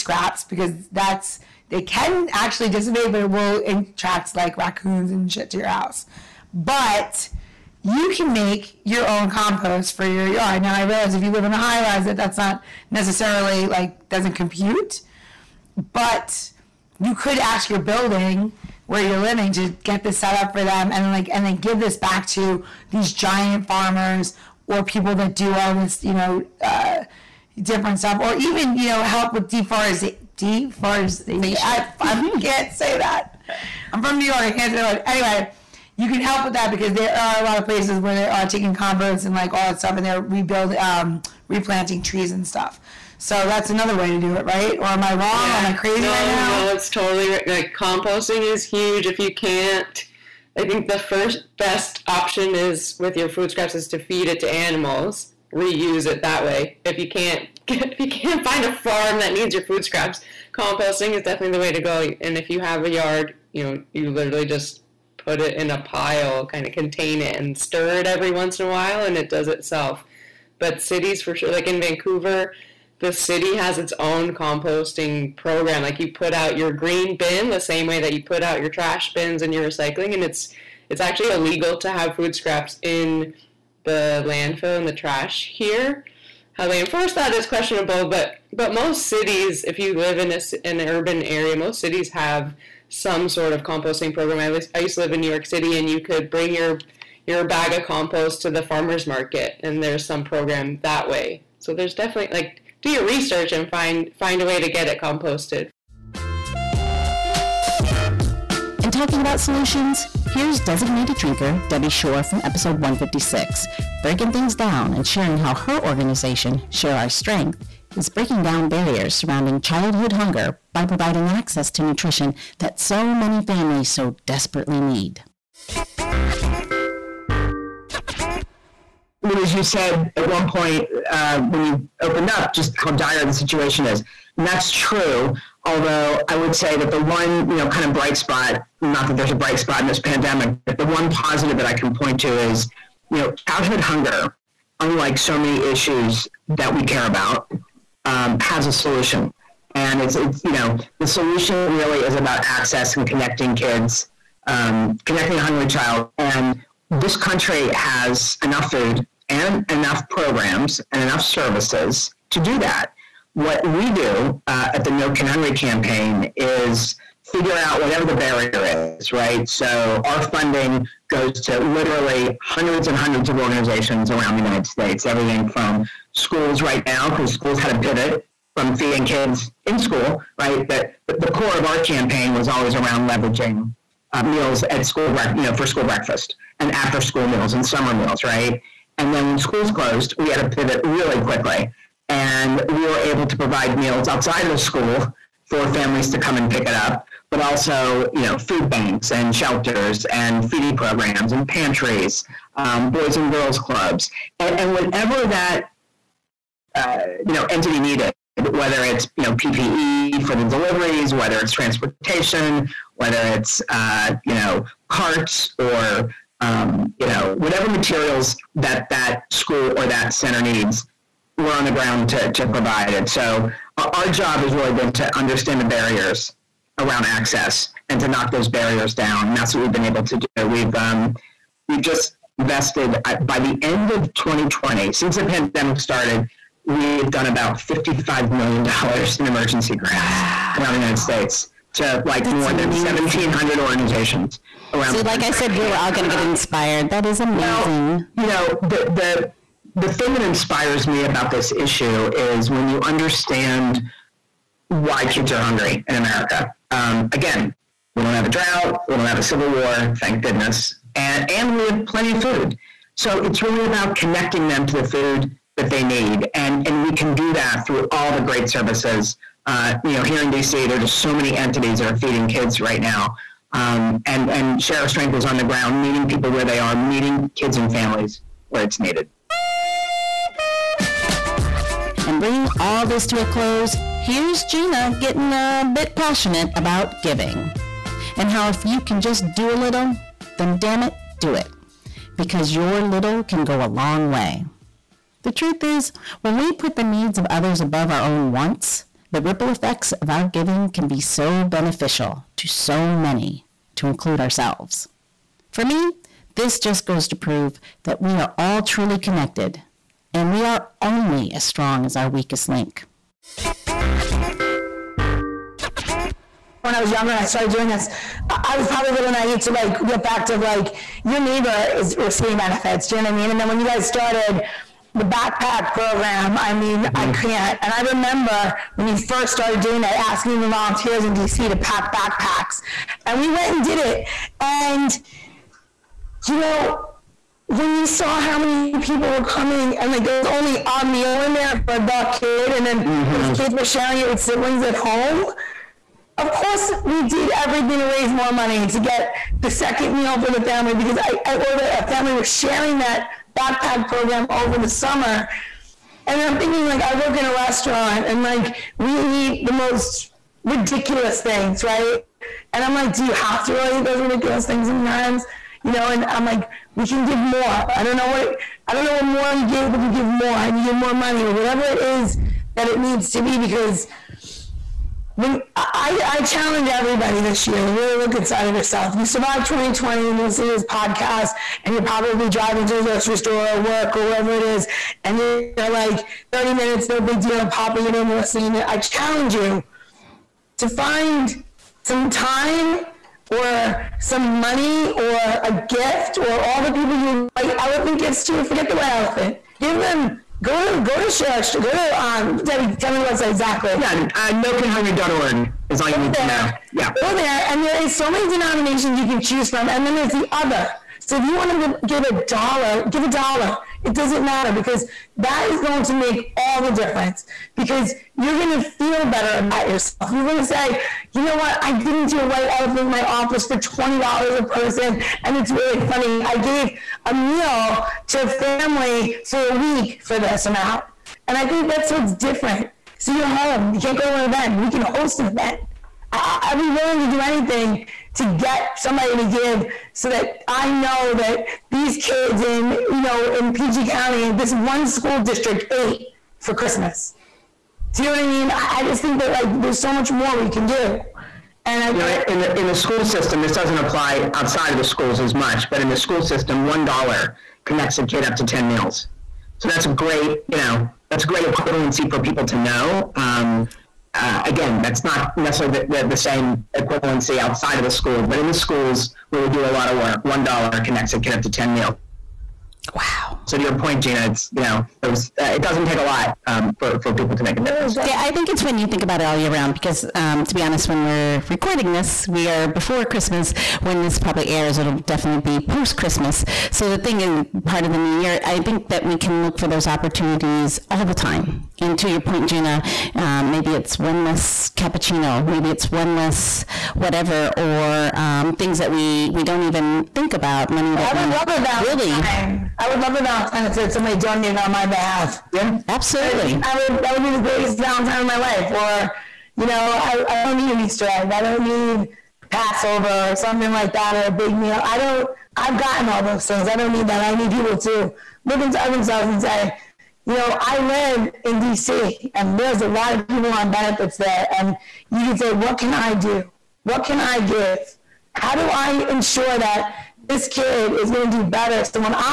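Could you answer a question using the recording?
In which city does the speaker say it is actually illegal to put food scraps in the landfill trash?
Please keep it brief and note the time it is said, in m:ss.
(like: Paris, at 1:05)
Vancouver, at 1:11.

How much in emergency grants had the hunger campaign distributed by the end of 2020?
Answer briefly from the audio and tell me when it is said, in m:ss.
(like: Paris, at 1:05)
$55 million, at 3:57.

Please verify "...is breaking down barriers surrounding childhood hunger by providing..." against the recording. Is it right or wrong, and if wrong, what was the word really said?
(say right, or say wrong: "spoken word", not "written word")
right.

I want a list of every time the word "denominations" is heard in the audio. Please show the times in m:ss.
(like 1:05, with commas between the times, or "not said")
6:48.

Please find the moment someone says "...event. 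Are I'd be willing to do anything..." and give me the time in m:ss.
7:15.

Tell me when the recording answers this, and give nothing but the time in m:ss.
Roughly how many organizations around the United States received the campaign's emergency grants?
4:02.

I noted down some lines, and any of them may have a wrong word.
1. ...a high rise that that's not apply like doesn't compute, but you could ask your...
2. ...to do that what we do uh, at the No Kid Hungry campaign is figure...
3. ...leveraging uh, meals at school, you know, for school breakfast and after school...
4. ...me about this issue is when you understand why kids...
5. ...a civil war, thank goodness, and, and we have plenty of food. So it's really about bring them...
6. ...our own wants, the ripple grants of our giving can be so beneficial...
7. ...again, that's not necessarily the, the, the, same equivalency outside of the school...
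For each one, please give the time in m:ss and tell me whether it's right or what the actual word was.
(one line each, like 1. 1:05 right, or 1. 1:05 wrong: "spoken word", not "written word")
1. 0:11 wrong: "necessarily", not "apply"
2. 2:42 right
3. 3:03 right
4. 4:10 right
5. 4:19 wrong: "connecting", not "bring"
6. 4:57 wrong: "effects", not "grants"
7. 7:44 right.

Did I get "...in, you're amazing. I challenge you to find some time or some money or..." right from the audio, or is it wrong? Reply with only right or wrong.
wrong.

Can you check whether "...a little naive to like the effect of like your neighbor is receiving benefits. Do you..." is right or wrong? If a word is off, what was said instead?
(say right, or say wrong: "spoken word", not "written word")
right.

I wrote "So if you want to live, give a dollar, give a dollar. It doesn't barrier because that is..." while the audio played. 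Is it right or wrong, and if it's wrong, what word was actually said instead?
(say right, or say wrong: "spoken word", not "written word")
wrong: "matter", not "barrier".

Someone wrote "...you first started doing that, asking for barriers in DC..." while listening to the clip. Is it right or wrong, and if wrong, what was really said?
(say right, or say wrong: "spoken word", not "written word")
wrong: "volunteers", not "barriers".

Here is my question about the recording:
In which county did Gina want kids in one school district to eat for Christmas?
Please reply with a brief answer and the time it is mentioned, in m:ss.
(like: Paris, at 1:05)
PG County, at 7:23.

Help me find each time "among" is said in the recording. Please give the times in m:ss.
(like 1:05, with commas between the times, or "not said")
not said.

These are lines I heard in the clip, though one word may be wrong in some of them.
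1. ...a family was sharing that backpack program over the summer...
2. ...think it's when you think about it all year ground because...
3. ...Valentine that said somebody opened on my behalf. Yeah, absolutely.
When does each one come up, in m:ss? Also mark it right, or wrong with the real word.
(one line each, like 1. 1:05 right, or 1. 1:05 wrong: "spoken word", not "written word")
1. 5:51 right
2. 7:58 wrong: "round", not "ground"
3. 8:23 wrong: "donated", not "opened".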